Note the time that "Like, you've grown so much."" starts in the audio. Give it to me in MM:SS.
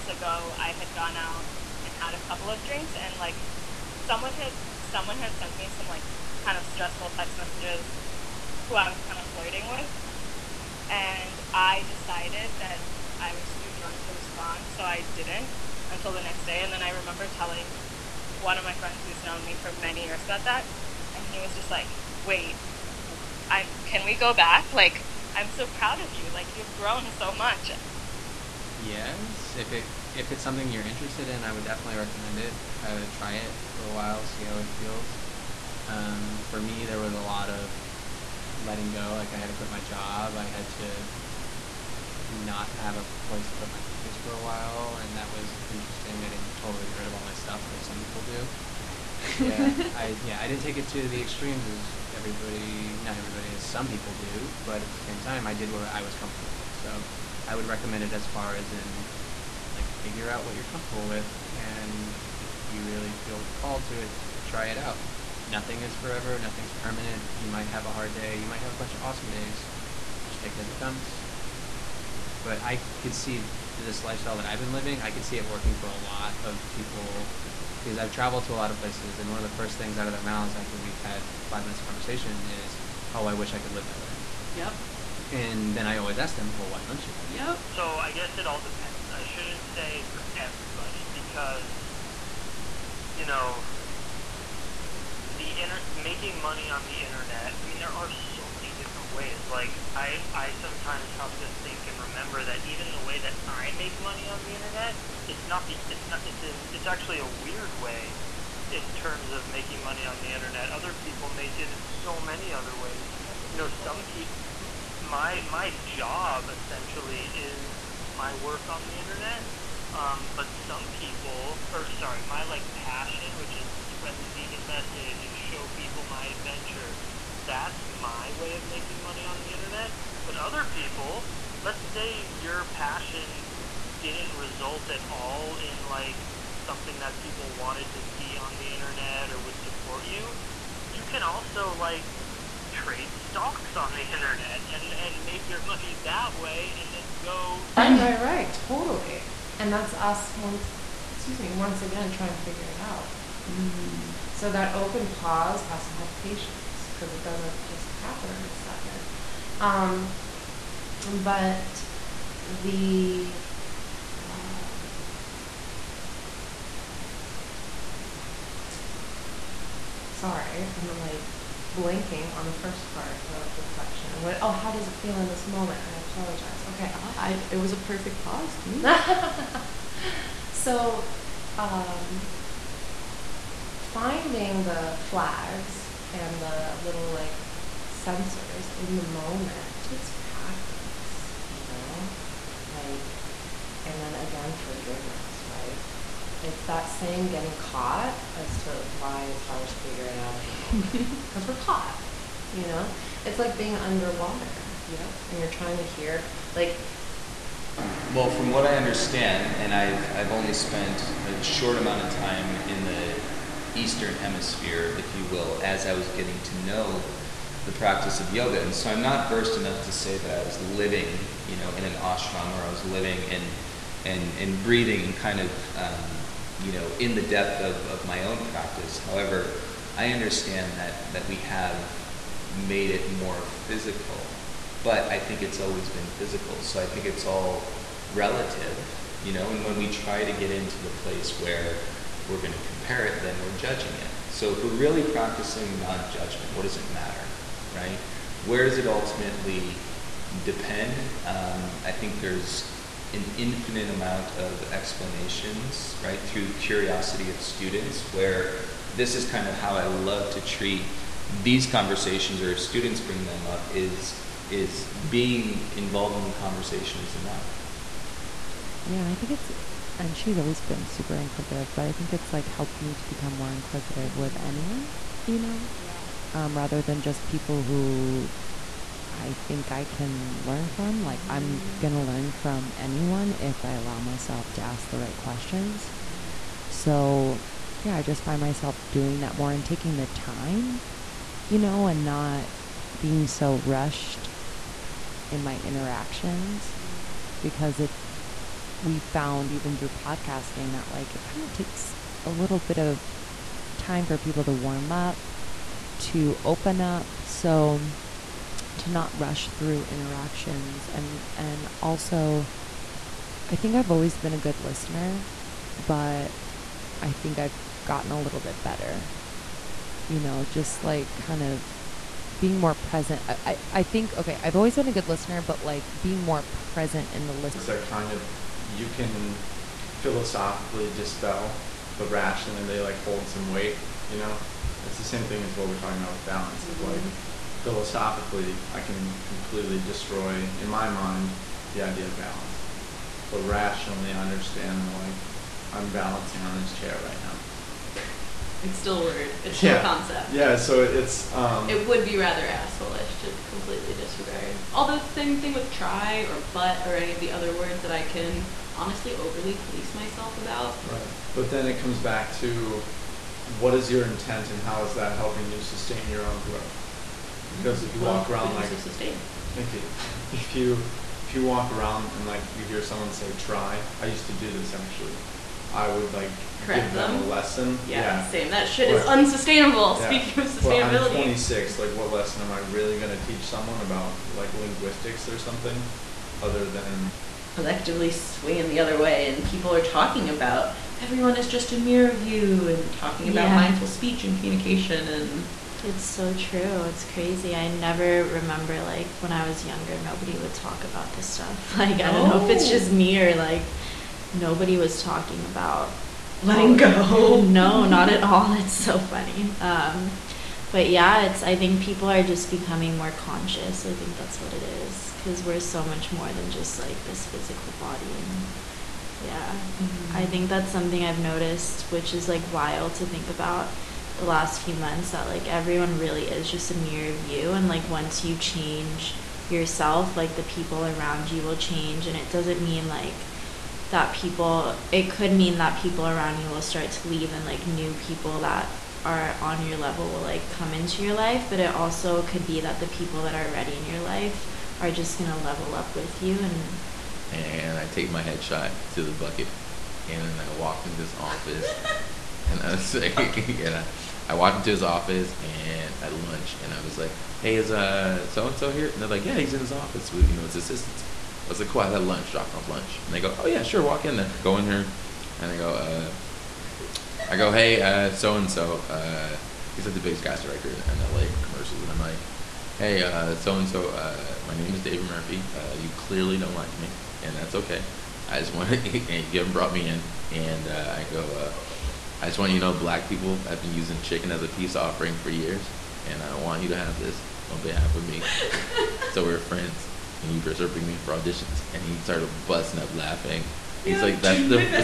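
00:26.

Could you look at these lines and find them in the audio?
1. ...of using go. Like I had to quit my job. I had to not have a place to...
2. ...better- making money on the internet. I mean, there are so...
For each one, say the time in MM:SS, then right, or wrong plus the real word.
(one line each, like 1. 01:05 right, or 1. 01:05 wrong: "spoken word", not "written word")
1. 00:37 wrong: "letting", not "using"
2. 01:35 wrong: "inter", not "better".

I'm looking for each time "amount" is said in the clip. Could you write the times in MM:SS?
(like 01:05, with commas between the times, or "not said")
03:31, 04:13.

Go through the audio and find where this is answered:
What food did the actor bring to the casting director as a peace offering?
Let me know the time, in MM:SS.
08:04.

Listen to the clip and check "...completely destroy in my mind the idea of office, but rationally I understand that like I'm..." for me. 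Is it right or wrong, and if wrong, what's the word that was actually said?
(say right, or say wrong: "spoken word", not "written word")
wrong: "balance", not "office".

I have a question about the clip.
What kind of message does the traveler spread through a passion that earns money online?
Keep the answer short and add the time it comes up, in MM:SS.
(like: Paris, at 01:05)
Vegan, at 02:04.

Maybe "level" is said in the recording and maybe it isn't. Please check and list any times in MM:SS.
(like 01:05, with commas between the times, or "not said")
07:19, 07:25.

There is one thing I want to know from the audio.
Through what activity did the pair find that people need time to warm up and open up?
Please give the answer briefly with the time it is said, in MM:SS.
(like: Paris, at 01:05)
Podcasting, at 04:59.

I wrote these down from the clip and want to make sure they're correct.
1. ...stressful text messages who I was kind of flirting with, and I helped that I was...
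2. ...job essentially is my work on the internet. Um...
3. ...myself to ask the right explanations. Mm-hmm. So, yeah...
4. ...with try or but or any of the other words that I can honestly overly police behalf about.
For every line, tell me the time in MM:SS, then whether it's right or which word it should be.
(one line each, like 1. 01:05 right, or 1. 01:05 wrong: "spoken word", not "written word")
1. 00:06 wrong: "decided", not "helped"
2. 01:55 right
3. 04:43 wrong: "questions", not "explanations"
4. 05:55 wrong: "myself", not "behalf".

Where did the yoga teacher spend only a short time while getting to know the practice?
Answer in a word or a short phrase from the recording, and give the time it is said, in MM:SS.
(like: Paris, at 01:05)
The Eastern Hemisphere, at 03:33.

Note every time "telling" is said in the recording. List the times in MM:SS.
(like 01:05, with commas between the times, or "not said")
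00:17.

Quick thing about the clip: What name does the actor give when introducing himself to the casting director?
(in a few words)
David Murphy.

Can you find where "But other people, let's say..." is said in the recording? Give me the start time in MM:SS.
02:10.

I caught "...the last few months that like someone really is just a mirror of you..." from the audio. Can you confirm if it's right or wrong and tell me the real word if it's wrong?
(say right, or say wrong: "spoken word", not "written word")
wrong: "everyone", not "someone".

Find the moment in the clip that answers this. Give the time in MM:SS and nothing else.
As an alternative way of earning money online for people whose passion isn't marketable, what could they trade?
02:23.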